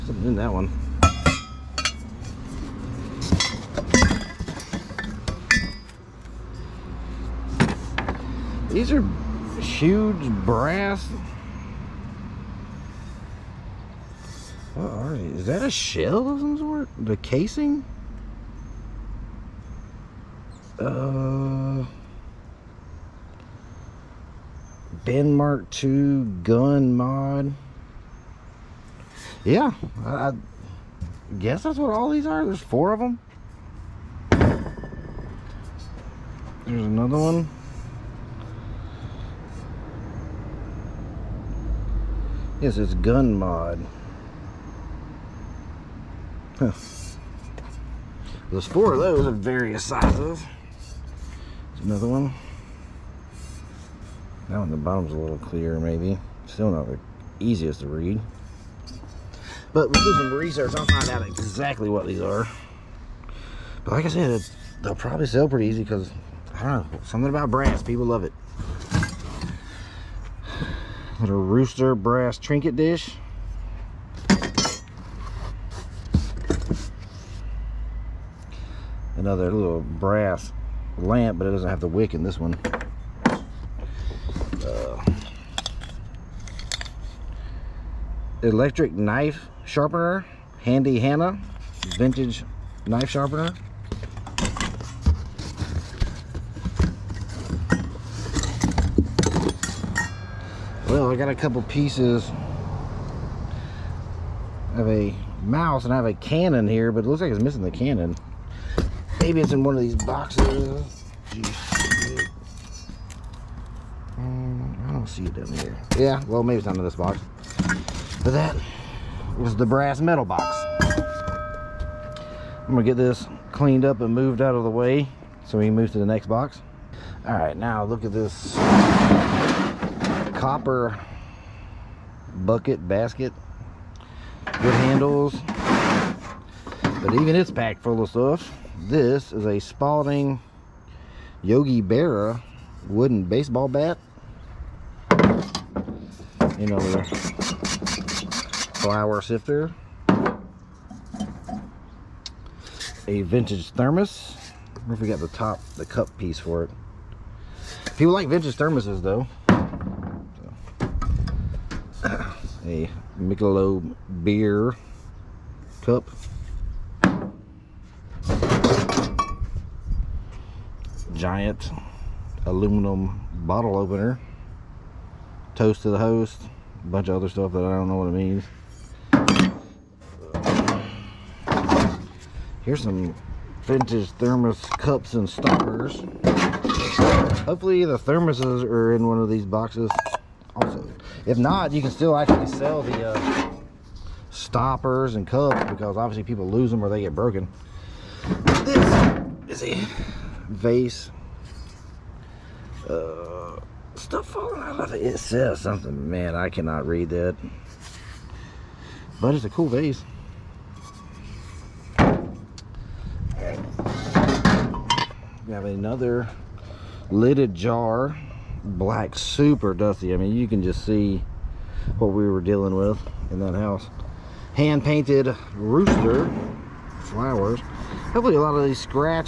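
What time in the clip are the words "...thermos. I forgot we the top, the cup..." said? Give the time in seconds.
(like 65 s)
153 s.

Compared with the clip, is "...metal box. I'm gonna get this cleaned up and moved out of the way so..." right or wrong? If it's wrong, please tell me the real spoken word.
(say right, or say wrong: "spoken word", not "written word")
right.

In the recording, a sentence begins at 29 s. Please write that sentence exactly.
Yeah, I, guess that's what all these are.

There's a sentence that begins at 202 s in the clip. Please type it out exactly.
Uh, stuff falling out of it.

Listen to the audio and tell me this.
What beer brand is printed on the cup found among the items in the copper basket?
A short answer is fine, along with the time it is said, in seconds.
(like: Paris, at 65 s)
Michelob, at 163 s.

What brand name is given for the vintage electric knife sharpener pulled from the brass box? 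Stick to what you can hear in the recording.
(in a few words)
Handy Hannah.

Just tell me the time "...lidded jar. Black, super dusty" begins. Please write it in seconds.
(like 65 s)
217 s.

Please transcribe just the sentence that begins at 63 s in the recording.
But like I said, they'll probably sell pretty easy because, I don't know, something about brass.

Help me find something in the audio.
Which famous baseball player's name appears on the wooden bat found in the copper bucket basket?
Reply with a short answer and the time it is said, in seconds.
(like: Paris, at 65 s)
Yogi Berra, at 141 s.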